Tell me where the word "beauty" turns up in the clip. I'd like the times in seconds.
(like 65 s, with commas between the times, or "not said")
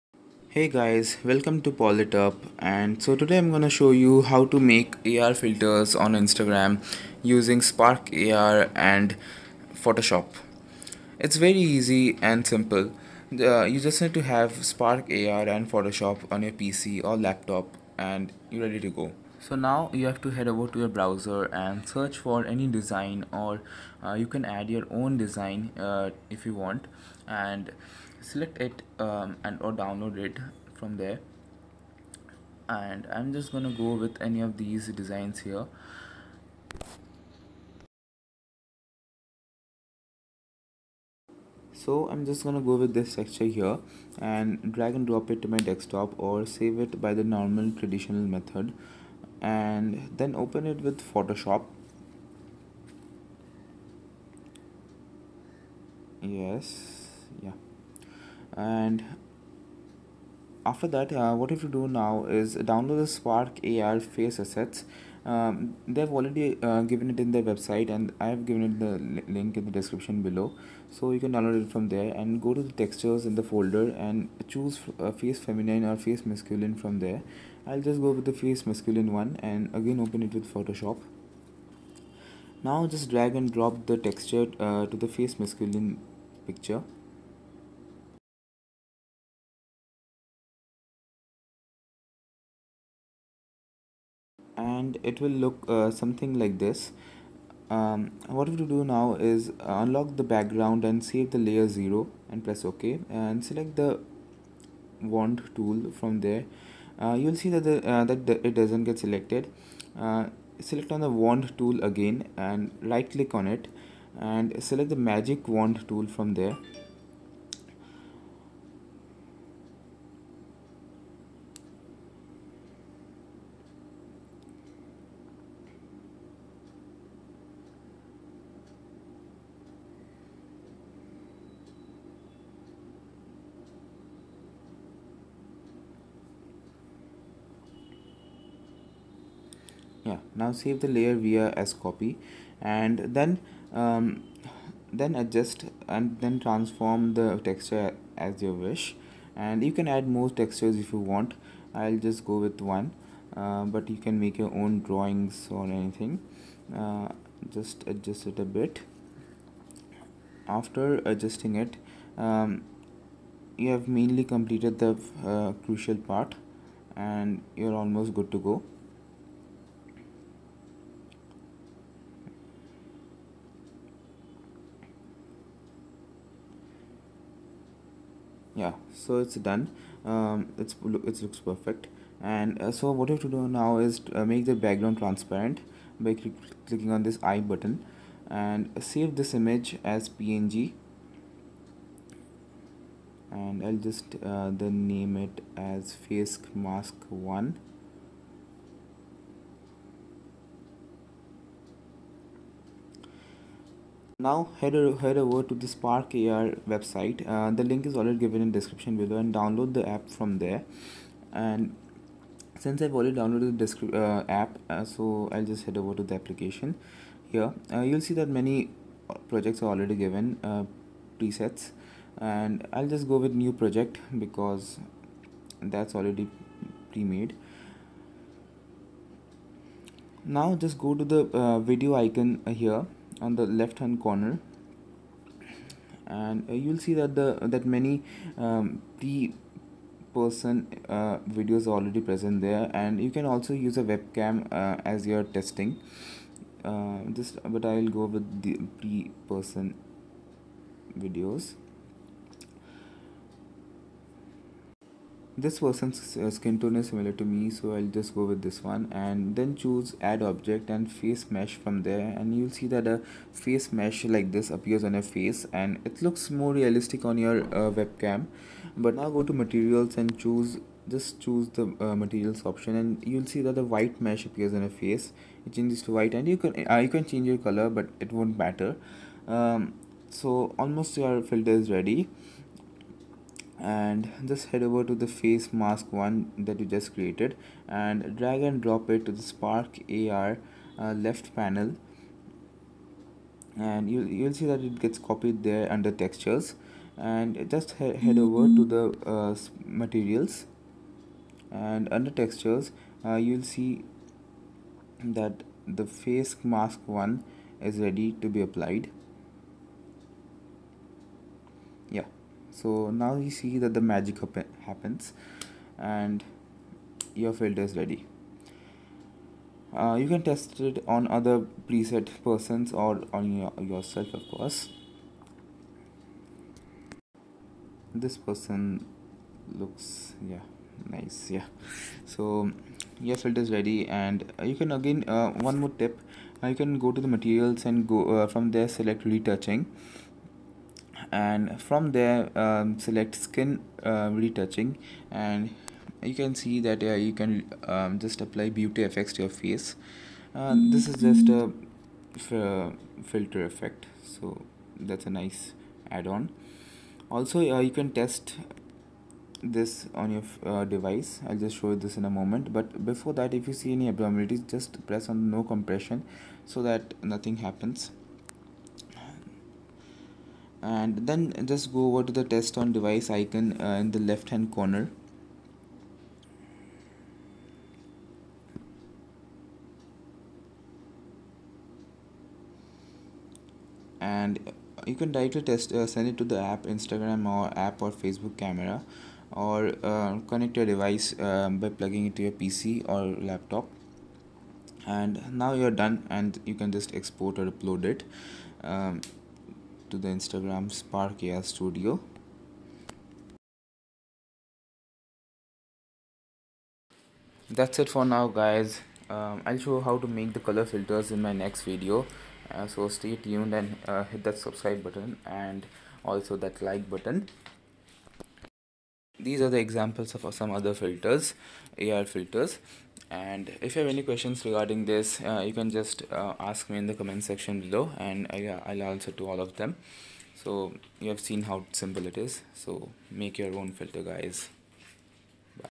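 348 s.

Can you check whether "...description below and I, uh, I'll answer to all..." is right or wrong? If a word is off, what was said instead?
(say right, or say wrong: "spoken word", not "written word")
wrong: "section", not "description".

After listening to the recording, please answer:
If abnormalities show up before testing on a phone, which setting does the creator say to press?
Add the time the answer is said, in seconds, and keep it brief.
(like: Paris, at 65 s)
no compression, at 365 s.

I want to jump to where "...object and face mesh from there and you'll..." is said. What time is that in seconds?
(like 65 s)
260 s.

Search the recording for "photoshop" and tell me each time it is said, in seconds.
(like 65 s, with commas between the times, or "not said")
9 s, 15 s, 51 s, 80 s.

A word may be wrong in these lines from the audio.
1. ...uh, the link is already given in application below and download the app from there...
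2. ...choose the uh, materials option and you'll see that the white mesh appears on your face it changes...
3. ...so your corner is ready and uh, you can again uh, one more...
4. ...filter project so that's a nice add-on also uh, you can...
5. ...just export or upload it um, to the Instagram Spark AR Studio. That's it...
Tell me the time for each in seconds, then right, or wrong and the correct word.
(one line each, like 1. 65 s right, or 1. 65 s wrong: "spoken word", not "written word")
1. 207 s wrong: "description", not "application"
2. 271 s right
3. 332 s wrong: "filter", not "corner"
4. 353 s wrong: "effect", not "project"
5. 396 s right.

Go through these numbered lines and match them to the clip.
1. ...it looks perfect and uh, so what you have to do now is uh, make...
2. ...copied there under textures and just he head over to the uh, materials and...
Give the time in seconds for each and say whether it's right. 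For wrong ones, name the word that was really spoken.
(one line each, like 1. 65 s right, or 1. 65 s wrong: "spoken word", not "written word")
1. 180 s right
2. 294 s right.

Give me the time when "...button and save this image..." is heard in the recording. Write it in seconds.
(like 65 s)
187 s.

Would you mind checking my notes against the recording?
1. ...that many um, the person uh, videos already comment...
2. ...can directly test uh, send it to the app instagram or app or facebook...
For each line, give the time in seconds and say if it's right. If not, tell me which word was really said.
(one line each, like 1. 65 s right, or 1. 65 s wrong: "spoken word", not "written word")
1. 237 s wrong: "present", not "comment"
2. 384 s right.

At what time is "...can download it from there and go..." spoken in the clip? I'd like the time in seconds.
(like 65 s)
71 s.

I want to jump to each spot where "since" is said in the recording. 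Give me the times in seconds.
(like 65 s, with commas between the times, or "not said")
212 s.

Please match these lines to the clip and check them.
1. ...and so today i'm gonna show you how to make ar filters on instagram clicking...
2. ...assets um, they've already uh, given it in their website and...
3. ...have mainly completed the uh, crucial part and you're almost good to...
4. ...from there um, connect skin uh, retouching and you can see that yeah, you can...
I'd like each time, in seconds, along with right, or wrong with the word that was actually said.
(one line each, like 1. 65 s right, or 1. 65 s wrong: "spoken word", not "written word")
1. 2 s wrong: "using", not "clicking"
2. 64 s right
3. 163 s right
4. 341 s wrong: "select", not "connect".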